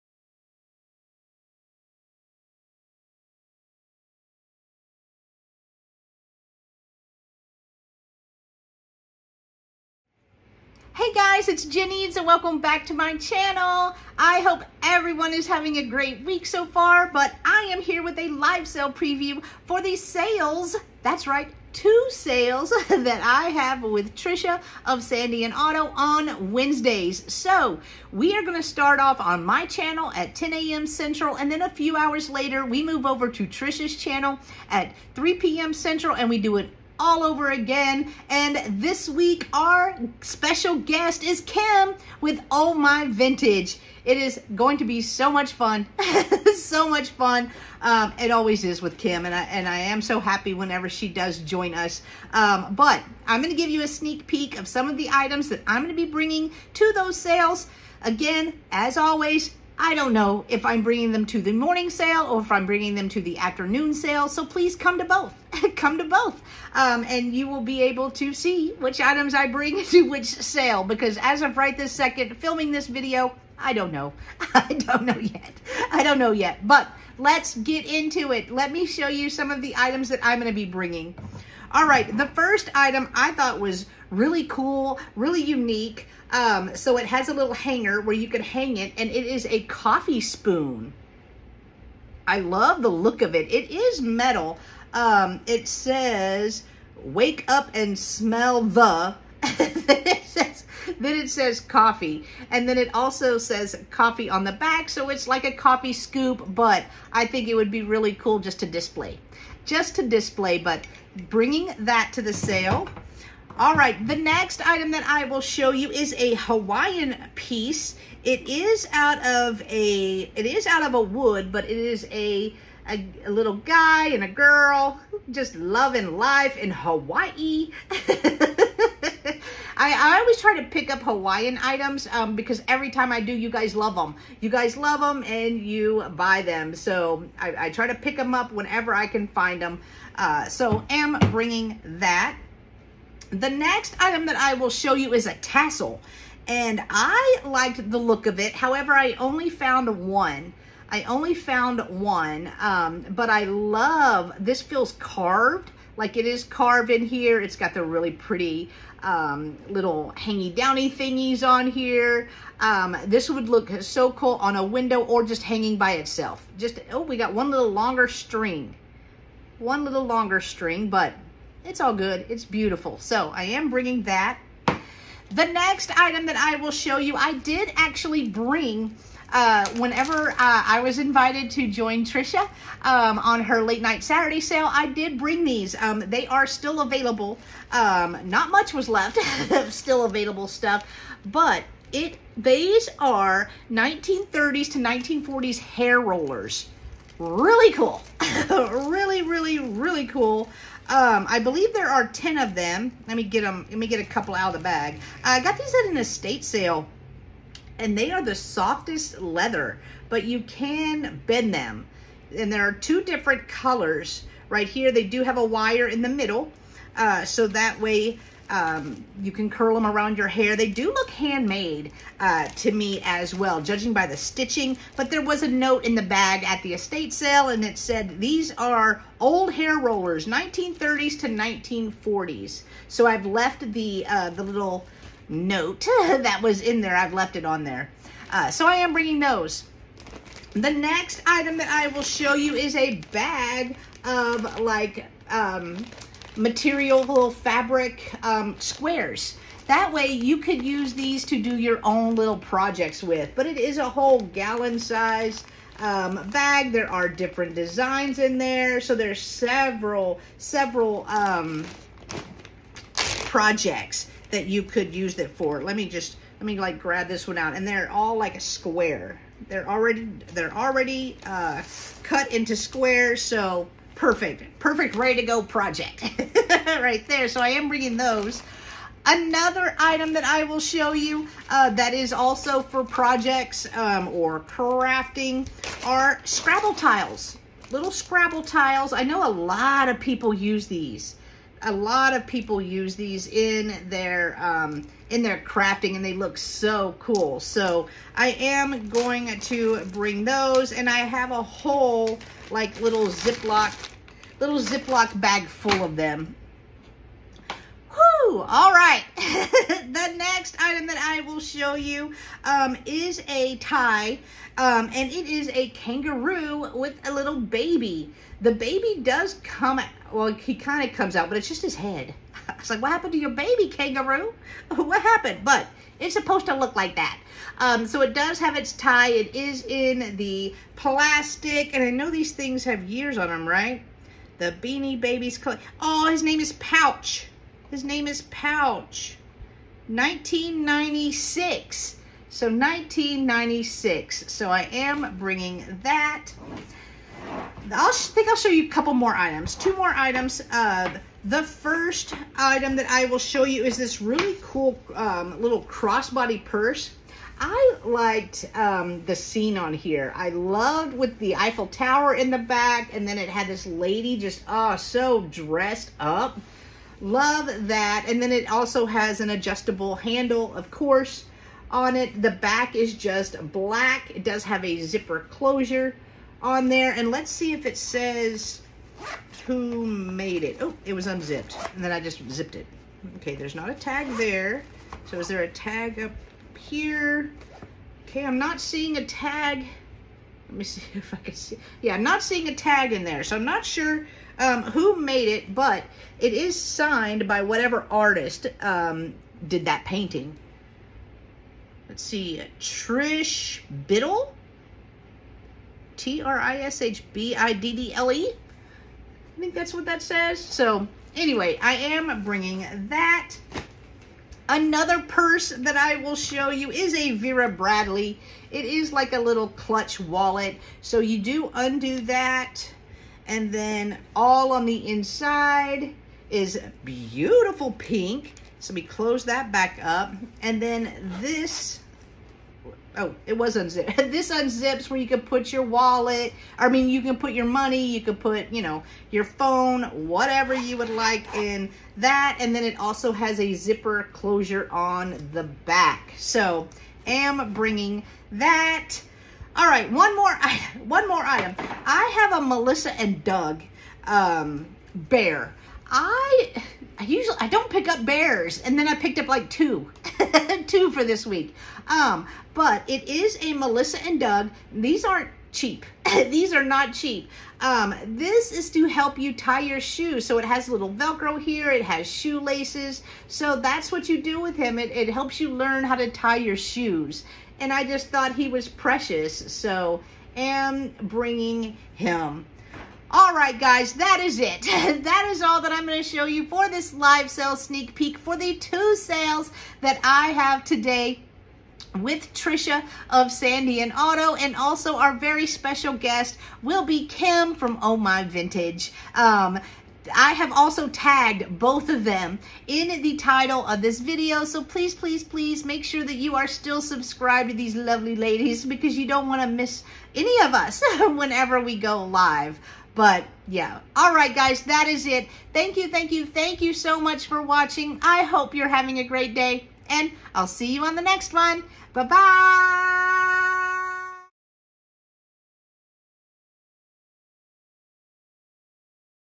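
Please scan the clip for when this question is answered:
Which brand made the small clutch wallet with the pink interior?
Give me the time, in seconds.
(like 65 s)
417 s.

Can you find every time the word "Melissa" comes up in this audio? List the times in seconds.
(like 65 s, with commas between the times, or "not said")
452 s, 463 s.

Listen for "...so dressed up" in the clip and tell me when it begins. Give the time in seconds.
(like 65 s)
364 s.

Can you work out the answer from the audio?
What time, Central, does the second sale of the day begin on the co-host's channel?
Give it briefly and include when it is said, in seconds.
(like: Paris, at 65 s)
3 p.m., at 35 s.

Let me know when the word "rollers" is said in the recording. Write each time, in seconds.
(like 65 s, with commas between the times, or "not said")
196 s, 229 s.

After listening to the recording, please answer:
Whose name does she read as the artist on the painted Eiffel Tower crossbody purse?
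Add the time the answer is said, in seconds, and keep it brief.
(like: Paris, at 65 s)
Trish Biddle, at 402 s.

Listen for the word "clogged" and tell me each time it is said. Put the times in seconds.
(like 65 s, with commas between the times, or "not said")
not said.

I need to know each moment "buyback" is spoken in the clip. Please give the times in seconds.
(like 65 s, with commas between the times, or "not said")
not said.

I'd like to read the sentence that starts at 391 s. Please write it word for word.
Yeah, I'm not seeing a tag in there.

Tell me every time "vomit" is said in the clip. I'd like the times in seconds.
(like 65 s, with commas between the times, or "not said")
not said.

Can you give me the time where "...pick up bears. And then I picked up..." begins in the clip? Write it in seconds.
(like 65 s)
457 s.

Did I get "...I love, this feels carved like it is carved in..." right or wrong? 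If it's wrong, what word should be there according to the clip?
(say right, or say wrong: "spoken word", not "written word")
right.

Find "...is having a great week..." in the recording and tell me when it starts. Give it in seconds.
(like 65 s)
15 s.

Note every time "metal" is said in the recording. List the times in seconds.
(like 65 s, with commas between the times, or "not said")
94 s.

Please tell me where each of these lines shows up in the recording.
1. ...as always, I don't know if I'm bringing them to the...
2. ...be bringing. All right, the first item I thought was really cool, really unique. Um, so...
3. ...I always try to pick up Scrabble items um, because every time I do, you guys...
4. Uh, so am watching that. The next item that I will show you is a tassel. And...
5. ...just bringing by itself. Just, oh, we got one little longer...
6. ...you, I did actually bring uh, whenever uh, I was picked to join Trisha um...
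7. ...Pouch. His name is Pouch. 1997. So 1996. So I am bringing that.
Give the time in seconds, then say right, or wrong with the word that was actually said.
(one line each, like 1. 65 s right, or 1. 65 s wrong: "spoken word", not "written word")
1. 58 s right
2. 80 s right
3. 130 s wrong: "Hawaiian", not "Scrabble"
4. 140 s wrong: "bringing", not "watching"
5. 165 s wrong: "hanging", not "bringing"
6. 176 s wrong: "invited", not "picked"
7. 336 s wrong: "1996", not "1997".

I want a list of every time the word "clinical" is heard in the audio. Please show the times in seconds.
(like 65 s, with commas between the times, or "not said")
not said.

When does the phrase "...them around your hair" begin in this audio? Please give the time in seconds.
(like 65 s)
219 s.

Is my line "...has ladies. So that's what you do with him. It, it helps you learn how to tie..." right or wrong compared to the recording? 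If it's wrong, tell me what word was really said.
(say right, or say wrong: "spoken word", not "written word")
wrong: "shoelaces", not "ladies".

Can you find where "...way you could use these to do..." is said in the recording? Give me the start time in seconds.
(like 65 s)
249 s.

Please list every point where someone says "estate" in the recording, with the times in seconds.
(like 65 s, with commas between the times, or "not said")
205 s, 226 s.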